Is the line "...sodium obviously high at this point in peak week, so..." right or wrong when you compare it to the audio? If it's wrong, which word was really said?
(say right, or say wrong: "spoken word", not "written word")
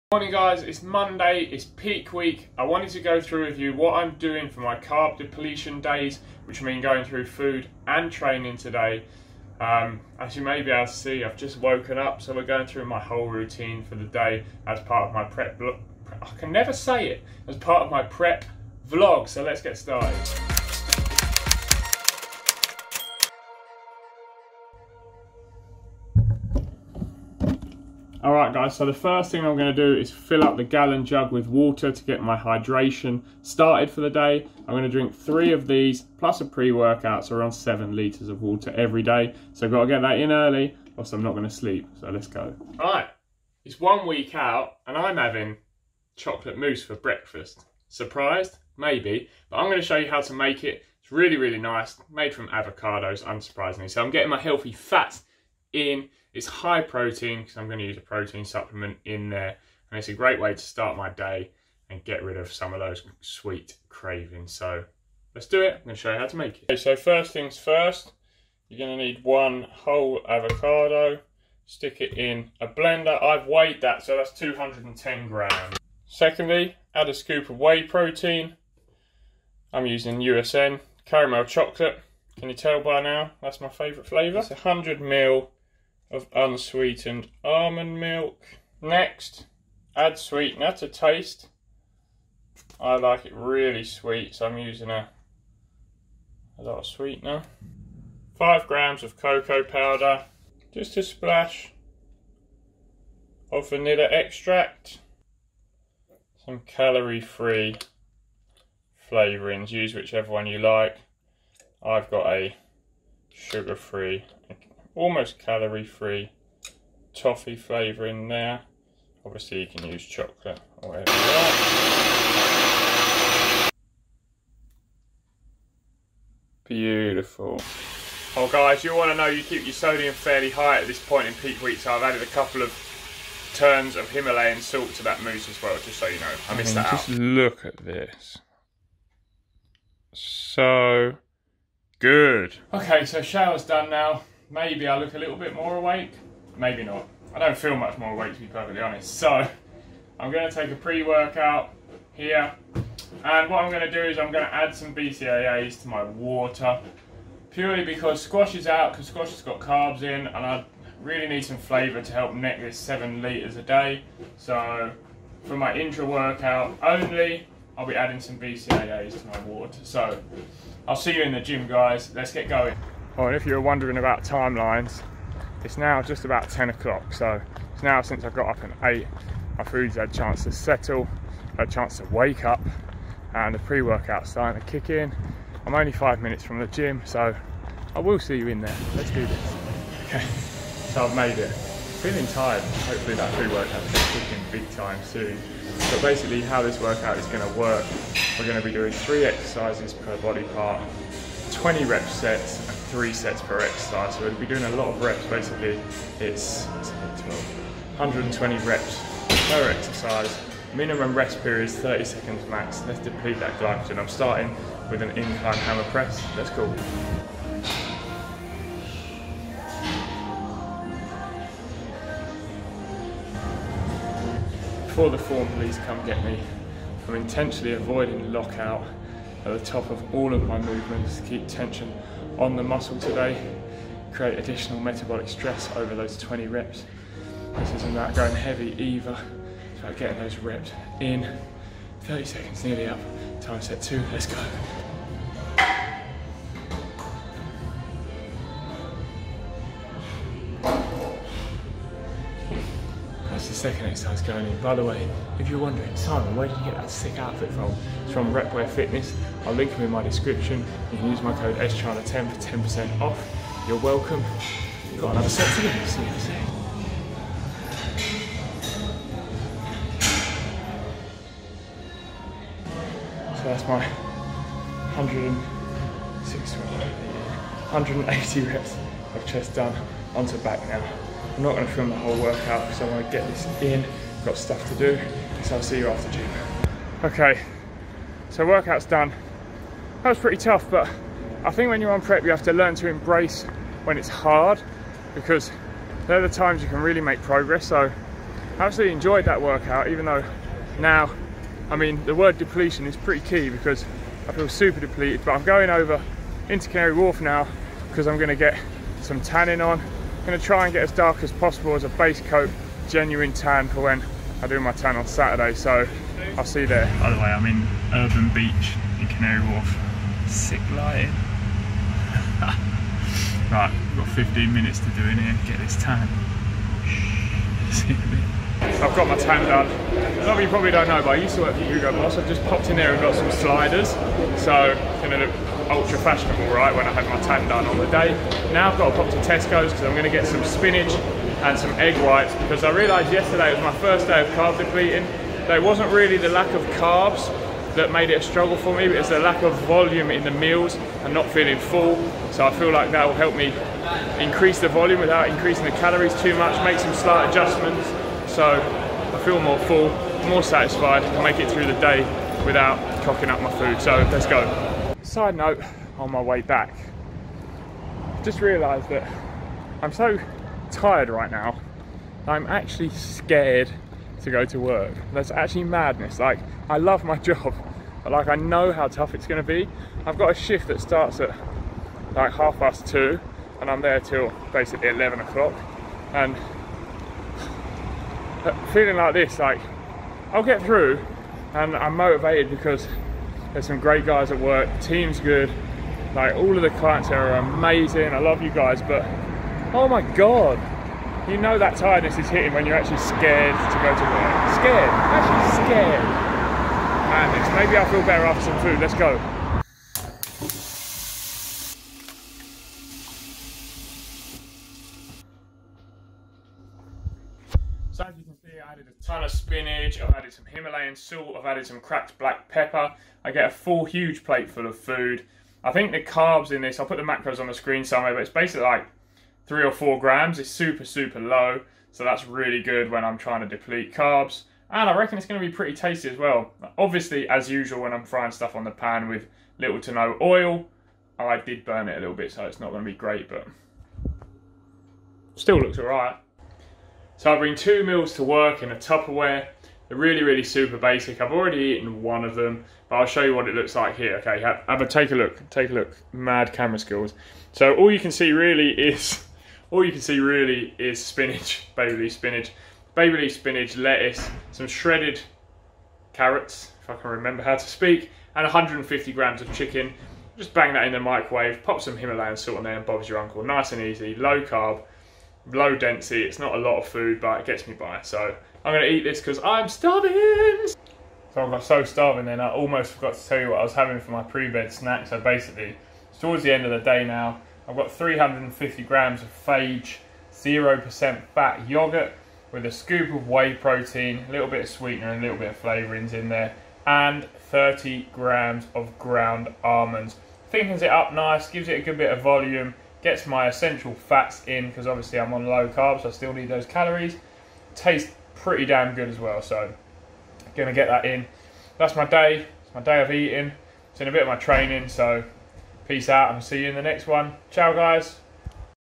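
wrong: "fairly", not "obviously".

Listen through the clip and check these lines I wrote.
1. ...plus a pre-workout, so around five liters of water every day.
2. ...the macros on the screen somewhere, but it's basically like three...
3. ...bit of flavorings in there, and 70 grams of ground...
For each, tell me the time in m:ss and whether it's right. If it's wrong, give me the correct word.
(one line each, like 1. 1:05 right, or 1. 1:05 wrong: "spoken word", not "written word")
1. 0:36 wrong: "seven", not "five"
2. 7:06 right
3. 8:15 wrong: "30", not "70".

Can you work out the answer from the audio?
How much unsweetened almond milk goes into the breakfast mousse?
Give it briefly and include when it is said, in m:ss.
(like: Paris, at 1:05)
100 ml, at 1:24.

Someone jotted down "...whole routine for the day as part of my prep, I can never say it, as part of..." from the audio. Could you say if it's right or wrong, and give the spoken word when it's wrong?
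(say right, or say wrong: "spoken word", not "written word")
right.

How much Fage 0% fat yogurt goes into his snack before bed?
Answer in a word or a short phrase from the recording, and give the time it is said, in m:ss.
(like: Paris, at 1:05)
350 grams, at 8:07.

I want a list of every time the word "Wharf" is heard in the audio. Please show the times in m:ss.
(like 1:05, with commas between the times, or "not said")
5:06, 5:19.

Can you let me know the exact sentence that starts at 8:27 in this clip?
Tastes pretty damn good as well.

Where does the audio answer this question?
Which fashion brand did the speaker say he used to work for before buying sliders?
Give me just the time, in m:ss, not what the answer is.
5:31.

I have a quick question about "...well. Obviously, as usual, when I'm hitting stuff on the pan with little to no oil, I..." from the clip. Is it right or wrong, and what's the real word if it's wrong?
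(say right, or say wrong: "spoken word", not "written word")
wrong: "frying", not "hitting".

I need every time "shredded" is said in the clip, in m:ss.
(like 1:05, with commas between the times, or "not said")
7:44.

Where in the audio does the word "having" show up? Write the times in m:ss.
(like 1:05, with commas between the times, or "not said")
0:45, 8:03.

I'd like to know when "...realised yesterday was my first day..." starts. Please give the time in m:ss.
5:42.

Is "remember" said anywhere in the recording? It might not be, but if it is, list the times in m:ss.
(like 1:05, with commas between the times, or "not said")
7:47.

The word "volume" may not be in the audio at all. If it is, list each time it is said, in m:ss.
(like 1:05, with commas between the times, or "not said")
5:49, 5:54, 8:22.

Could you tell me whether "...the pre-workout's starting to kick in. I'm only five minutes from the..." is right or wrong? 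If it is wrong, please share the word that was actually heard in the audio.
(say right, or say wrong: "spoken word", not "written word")
right.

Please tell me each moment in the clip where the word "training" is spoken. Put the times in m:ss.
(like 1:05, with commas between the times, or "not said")
0:08, 8:34.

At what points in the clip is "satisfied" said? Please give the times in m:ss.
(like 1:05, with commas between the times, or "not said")
6:00.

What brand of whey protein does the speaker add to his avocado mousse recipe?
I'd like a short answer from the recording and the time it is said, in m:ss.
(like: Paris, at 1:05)
USN, at 1:20.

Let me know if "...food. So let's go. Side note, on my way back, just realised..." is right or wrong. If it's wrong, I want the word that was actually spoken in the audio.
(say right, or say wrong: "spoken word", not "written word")
right.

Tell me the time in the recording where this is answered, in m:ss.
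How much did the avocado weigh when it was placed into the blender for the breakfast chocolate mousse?
1:14.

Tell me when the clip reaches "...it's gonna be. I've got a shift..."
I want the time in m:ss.
6:19.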